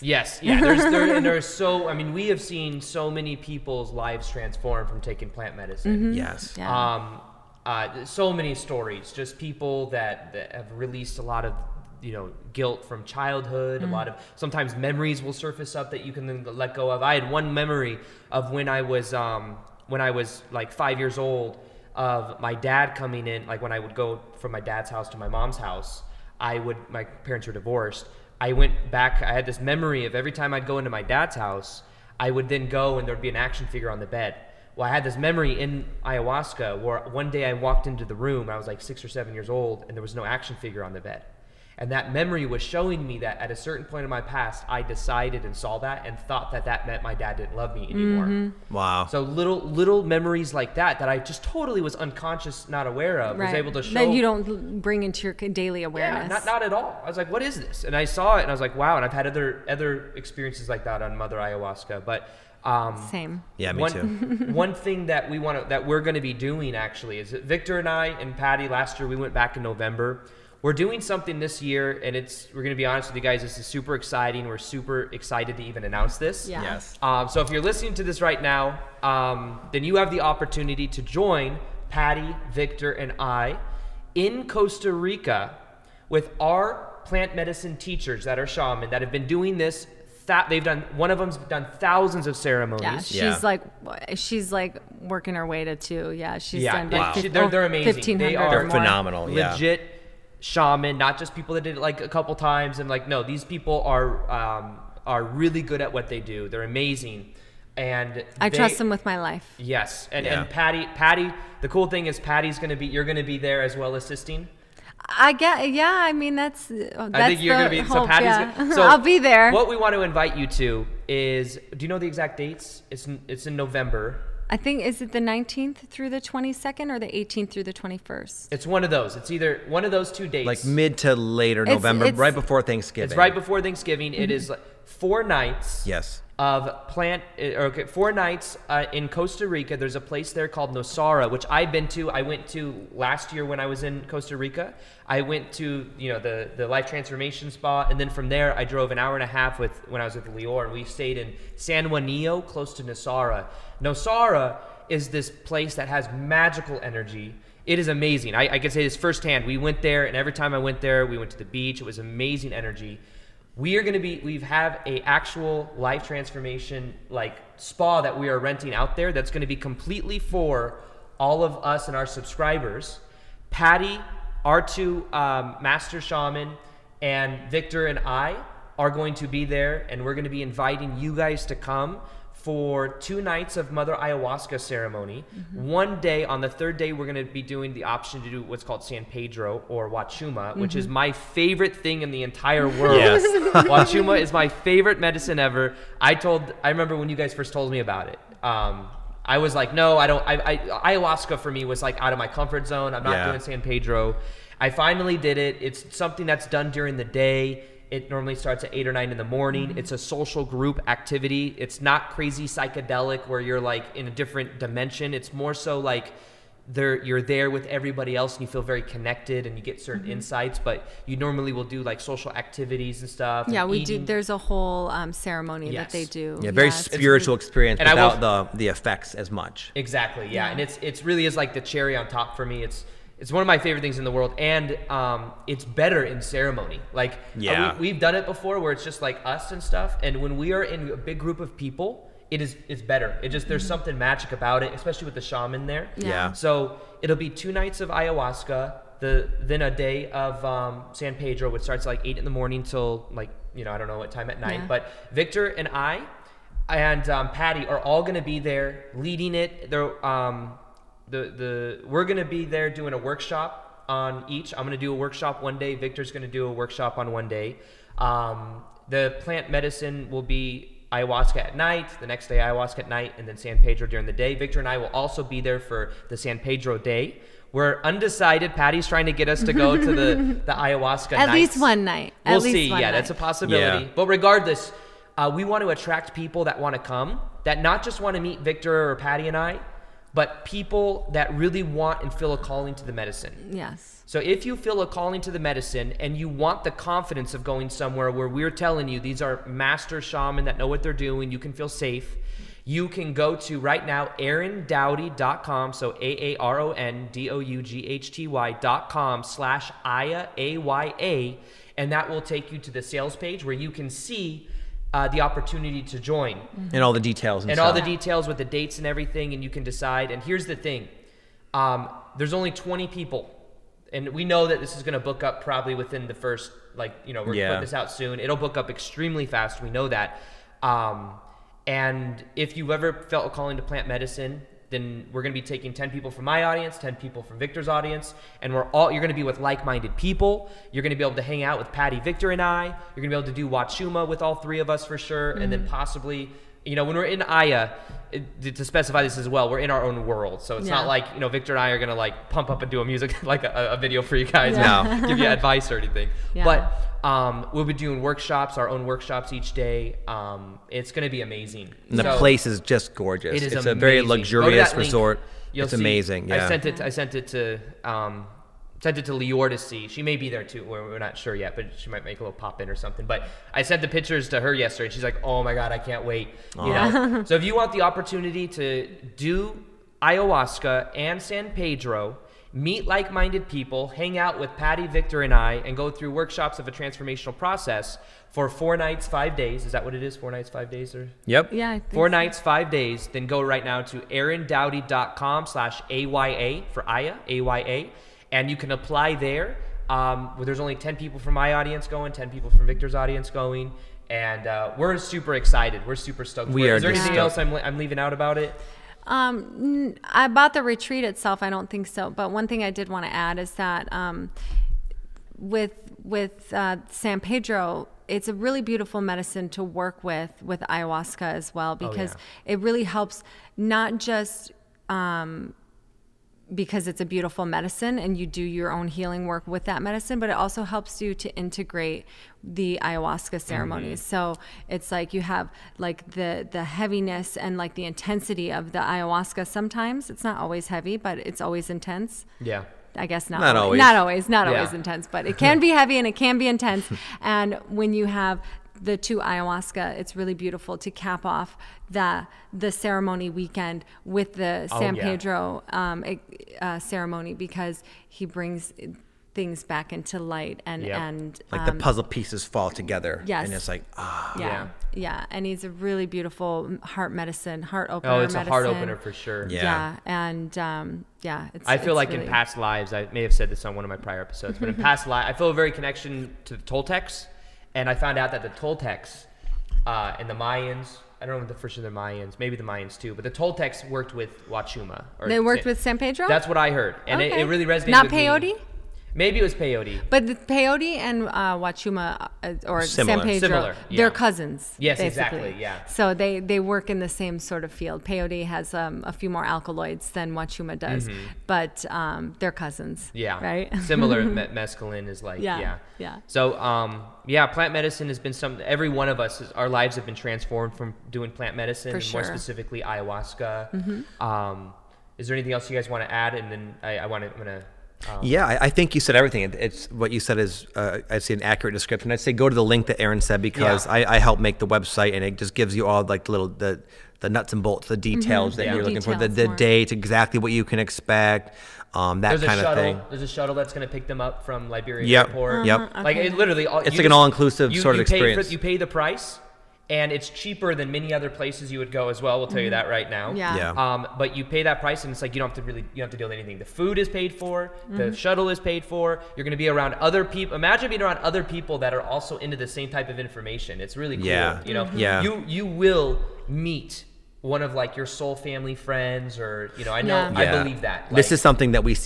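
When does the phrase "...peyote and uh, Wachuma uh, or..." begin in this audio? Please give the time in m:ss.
8:10.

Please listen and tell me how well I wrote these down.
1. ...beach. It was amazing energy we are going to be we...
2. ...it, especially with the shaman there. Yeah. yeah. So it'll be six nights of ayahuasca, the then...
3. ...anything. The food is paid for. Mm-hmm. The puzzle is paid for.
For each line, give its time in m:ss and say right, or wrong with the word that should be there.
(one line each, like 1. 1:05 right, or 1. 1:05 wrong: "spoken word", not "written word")
1. 2:41 right
2. 4:04 wrong: "two", not "six"
3. 9:06 wrong: "shuttle", not "puzzle".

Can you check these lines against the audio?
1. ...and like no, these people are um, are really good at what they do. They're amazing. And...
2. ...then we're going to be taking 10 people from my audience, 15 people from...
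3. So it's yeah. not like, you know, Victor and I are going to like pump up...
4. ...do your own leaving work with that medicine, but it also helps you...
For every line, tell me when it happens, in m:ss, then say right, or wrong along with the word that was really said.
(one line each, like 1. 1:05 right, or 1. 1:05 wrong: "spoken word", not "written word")
1. 1:42 right
2. 5:34 wrong: "10", not "15"
3. 5:50 right
4. 7:08 wrong: "healing", not "leaving".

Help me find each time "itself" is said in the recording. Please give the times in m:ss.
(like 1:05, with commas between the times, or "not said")
6:51.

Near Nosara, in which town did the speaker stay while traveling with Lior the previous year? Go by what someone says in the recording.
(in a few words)
San Juanillo.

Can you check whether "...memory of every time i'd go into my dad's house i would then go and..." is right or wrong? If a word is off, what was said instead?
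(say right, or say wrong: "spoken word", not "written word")
right.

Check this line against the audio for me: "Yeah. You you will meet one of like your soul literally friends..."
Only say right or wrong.
wrong.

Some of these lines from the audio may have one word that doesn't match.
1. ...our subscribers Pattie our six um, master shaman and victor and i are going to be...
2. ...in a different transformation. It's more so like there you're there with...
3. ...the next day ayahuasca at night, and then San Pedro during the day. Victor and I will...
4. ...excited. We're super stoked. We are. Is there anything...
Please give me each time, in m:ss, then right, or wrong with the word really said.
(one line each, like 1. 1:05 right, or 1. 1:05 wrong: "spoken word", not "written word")
1. 2:51 wrong: "two", not "six"
2. 3:33 wrong: "dimension", not "transformation"
3. 4:32 right
4. 6:45 right.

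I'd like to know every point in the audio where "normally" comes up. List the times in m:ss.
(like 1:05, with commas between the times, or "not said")
3:28, 3:41.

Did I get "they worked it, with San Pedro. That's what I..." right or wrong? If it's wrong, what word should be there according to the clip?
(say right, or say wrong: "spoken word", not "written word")
right.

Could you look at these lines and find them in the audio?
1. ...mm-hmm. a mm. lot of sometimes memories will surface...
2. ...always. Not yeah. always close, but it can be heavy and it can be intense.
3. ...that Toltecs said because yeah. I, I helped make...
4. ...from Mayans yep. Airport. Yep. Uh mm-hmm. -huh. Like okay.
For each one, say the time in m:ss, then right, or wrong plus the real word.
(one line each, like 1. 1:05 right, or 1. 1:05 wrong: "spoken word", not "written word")
1. 0:13 right
2. 7:23 wrong: "intense", not "close"
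3. 8:42 wrong: "Aaron", not "Toltecs"
4. 8:54 wrong: "Liberia", not "Mayans".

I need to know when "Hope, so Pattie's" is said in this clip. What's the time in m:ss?
1:57.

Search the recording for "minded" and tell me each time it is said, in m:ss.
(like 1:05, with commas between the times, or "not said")
5:39, 6:22.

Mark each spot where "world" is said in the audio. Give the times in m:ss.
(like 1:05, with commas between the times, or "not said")
3:12, 3:54, 5:50.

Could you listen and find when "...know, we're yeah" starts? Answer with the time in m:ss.
5:27.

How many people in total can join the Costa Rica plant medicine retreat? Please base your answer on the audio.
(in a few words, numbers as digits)
20.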